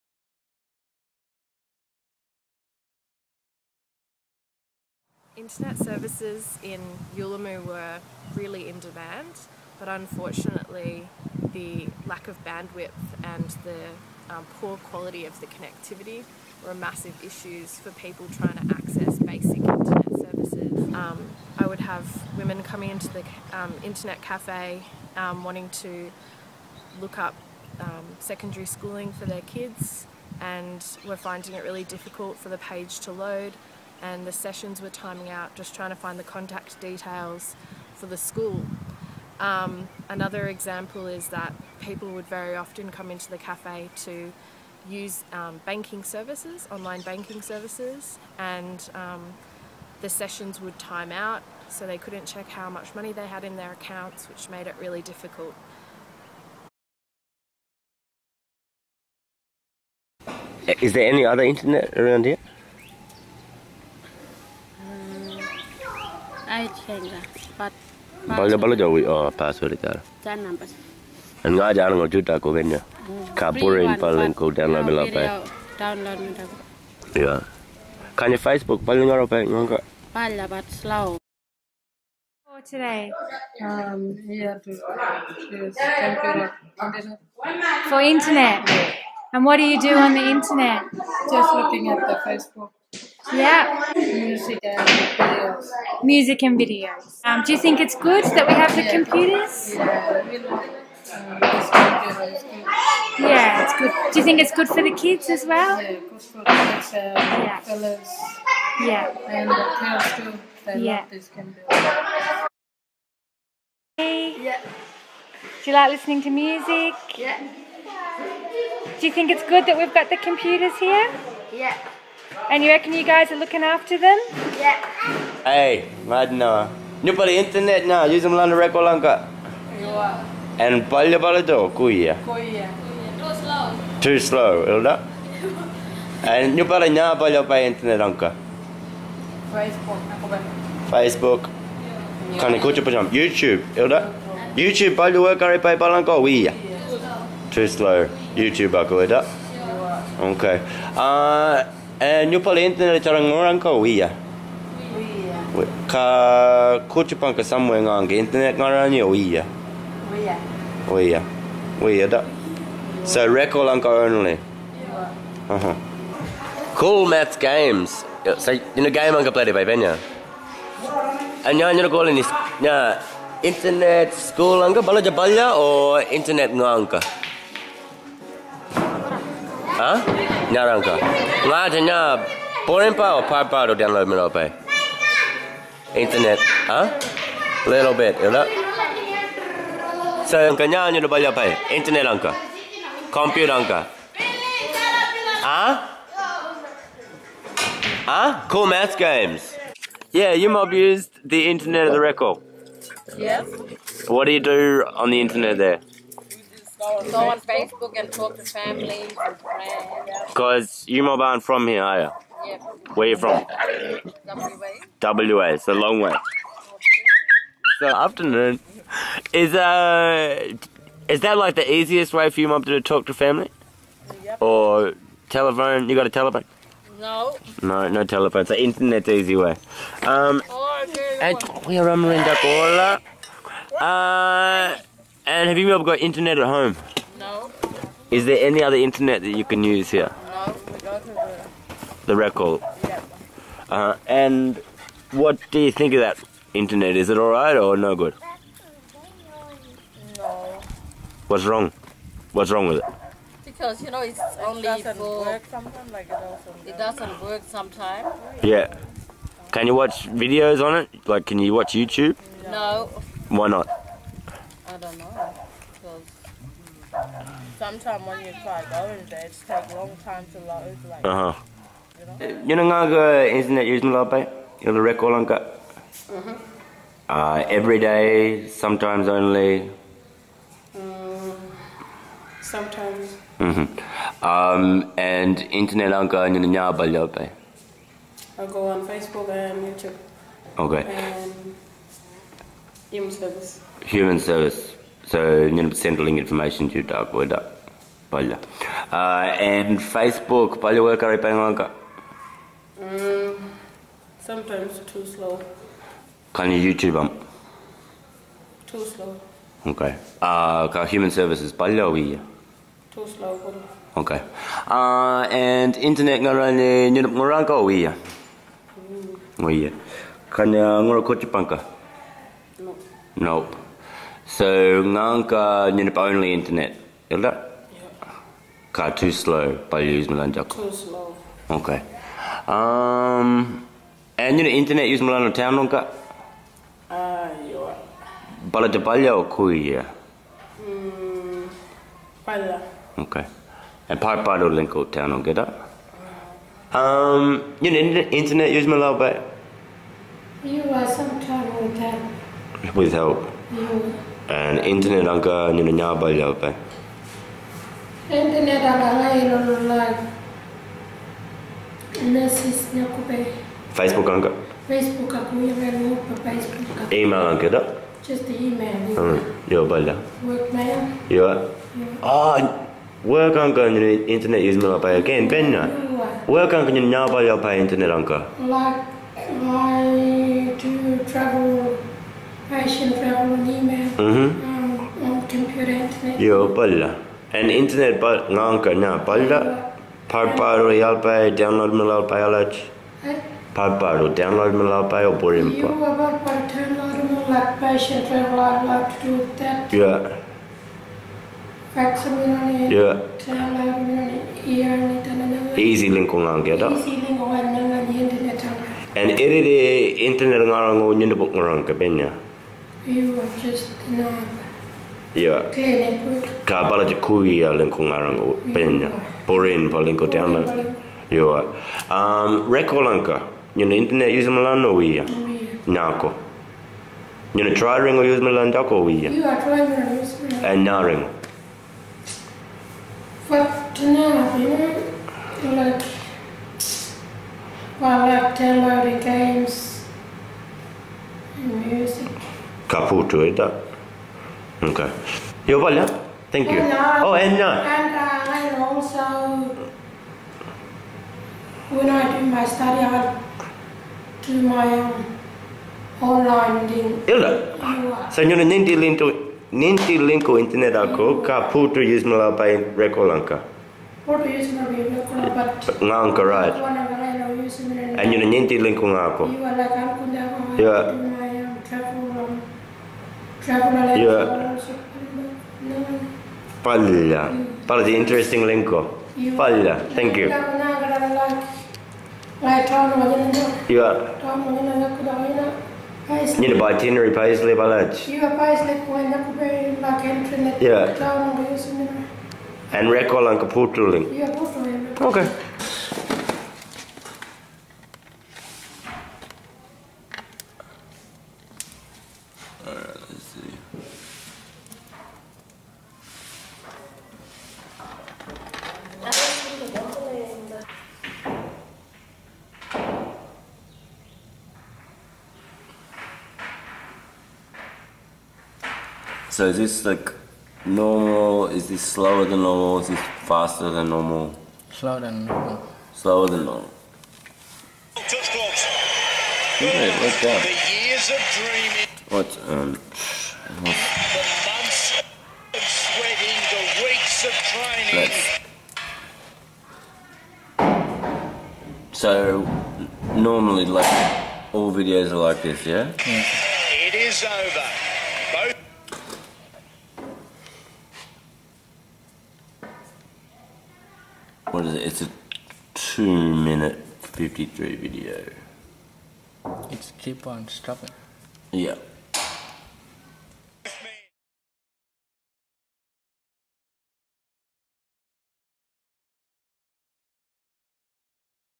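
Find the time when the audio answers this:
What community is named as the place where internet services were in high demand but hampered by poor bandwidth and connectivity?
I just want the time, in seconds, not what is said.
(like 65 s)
7 s.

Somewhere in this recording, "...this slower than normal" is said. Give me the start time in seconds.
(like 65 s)
521 s.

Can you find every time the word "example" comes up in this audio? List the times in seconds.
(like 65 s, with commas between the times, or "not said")
40 s.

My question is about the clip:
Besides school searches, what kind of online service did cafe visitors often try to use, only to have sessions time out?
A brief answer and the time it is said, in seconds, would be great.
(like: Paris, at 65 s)
online banking services, at 46 s.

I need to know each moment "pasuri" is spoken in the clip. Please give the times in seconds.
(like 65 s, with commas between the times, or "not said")
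69 s.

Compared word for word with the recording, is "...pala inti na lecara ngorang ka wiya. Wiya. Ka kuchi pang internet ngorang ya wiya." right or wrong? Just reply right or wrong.
right.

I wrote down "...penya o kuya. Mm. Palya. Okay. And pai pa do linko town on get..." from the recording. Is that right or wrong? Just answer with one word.
wrong.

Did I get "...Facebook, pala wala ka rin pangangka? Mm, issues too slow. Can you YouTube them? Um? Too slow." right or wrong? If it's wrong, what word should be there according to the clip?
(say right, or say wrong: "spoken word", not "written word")
wrong: "sometimes", not "issues".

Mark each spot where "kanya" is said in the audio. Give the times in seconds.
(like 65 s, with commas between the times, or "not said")
190 s, 320 s.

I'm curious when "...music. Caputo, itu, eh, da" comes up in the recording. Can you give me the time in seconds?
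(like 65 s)
441 s.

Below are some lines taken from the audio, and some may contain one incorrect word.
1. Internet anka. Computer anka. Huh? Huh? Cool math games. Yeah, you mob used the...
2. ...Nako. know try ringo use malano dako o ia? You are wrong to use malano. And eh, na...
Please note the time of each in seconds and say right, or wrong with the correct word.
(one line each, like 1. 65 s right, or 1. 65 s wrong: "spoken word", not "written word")
1. 191 s right
2. 425 s wrong: "trying", not "wrong".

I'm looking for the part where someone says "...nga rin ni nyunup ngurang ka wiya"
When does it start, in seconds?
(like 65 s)
316 s.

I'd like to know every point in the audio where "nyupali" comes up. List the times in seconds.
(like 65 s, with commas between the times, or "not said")
127 s, 136 s.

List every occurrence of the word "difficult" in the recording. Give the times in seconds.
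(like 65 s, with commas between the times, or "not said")
31 s, 55 s.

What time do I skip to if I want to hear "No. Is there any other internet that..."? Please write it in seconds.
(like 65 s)
237 s.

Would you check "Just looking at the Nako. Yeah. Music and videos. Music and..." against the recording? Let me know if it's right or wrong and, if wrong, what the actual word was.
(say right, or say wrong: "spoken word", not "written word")
wrong: "Facebook", not "Nako".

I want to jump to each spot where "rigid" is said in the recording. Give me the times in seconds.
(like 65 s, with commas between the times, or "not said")
not said.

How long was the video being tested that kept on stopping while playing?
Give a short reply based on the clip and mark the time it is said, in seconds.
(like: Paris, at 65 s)
2 minutes 53, at 555 s.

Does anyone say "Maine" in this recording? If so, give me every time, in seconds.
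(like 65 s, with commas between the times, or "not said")
not said.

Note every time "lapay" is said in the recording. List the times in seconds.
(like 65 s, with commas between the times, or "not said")
273 s, 286 s.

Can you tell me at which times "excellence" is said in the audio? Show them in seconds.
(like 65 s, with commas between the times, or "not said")
not said.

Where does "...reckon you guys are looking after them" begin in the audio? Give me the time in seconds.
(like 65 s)
122 s.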